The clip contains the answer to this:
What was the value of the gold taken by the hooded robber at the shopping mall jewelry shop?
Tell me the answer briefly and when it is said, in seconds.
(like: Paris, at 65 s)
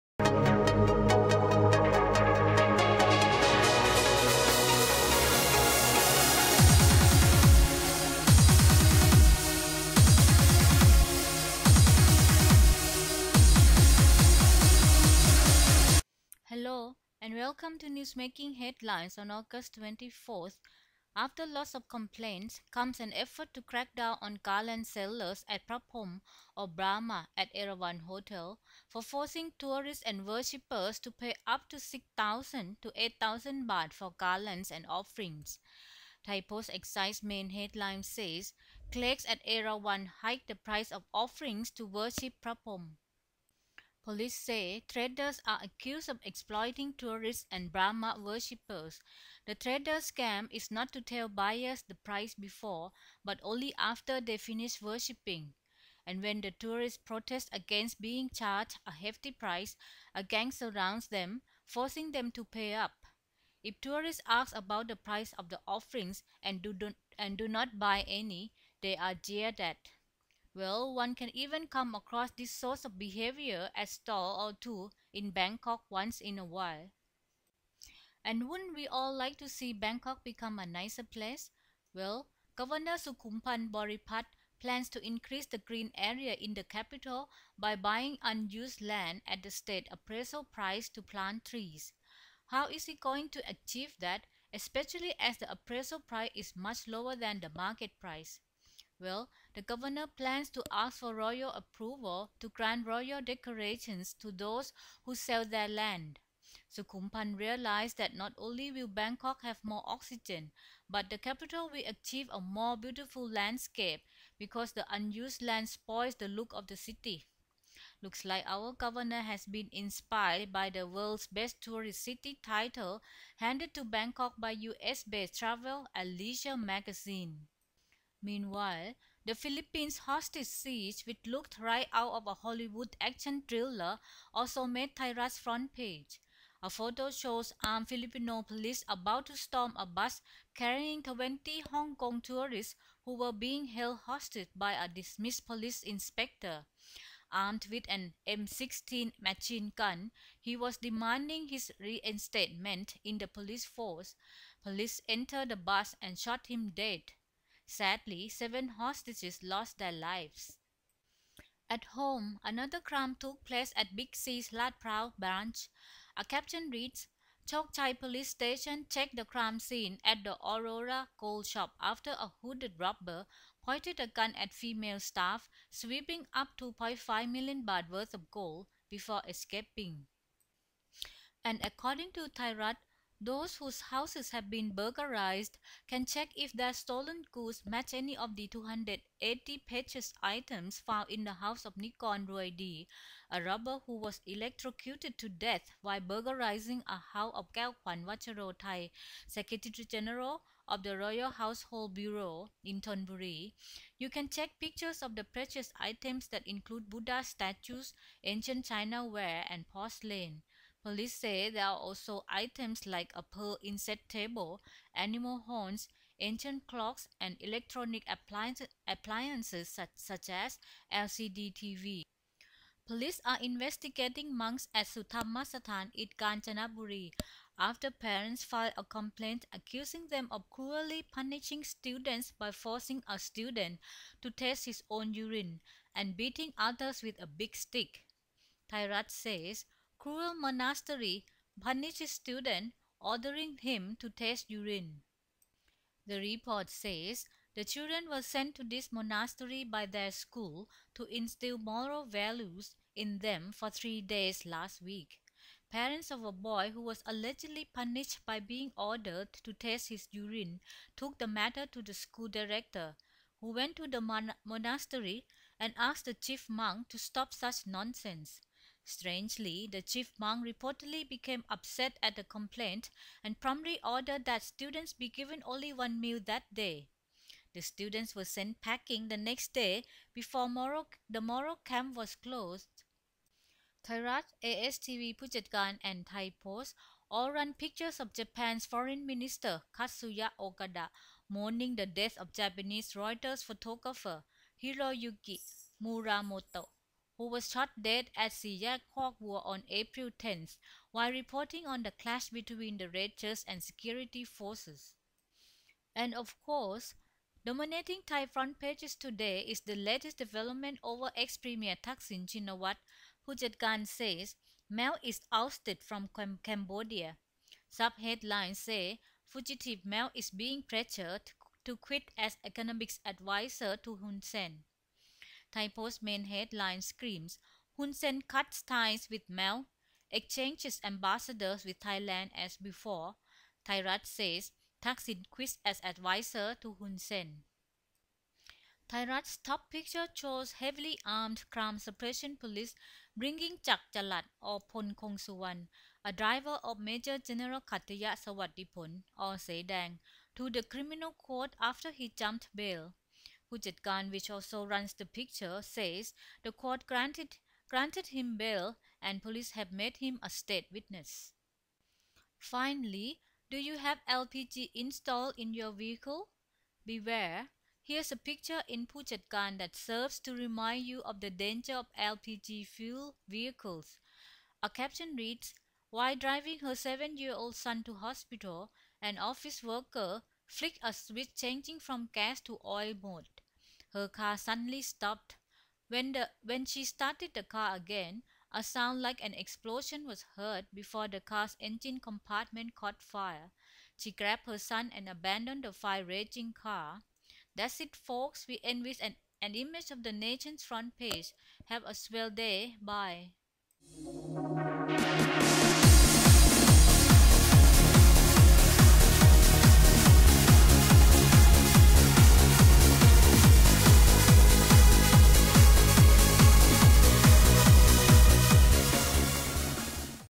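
2.5 million baht, at 176 s.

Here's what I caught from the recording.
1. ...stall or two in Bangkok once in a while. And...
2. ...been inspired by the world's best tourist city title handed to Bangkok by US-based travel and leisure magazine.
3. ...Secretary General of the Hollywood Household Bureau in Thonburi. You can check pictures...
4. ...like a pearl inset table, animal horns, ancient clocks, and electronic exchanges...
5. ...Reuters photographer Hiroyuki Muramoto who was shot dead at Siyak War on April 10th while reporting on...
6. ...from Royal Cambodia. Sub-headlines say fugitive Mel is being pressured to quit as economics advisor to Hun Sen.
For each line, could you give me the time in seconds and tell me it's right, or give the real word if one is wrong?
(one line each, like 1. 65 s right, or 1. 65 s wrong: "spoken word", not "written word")
1. 73 s right
2. 119 s right
3. 199 s wrong: "Royal", not "Hollywood"
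4. 212 s wrong: "appliances", not "exchanges"
5. 293 s right
6. 315 s wrong: "Cam", not "Royal".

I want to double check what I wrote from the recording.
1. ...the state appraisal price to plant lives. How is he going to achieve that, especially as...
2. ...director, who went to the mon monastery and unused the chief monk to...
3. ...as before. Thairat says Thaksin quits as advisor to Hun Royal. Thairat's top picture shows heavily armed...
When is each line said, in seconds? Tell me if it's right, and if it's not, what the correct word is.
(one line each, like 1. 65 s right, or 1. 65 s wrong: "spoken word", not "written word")
1. 89 s wrong: "trees", not "lives"
2. 262 s wrong: "asked", not "unused"
3. 332 s wrong: "Sen", not "Royal".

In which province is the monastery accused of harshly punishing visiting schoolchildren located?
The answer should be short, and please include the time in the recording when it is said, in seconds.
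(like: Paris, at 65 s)
Kanchanaburi, at 226 s.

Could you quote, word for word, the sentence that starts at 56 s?
And when the tourists protest against being charged a hefty price, a gang surrounds them, forcing them to pay up.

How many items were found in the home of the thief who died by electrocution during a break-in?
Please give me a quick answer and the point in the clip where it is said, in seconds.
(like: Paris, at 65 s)
280, at 188 s.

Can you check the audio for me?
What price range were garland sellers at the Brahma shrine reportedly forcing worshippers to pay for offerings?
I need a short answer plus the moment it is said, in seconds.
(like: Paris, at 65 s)
6,000 to 8,000 baht, at 31 s.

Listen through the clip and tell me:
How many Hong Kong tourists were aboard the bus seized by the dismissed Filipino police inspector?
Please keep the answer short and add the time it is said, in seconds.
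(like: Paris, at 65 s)
20, at 141 s.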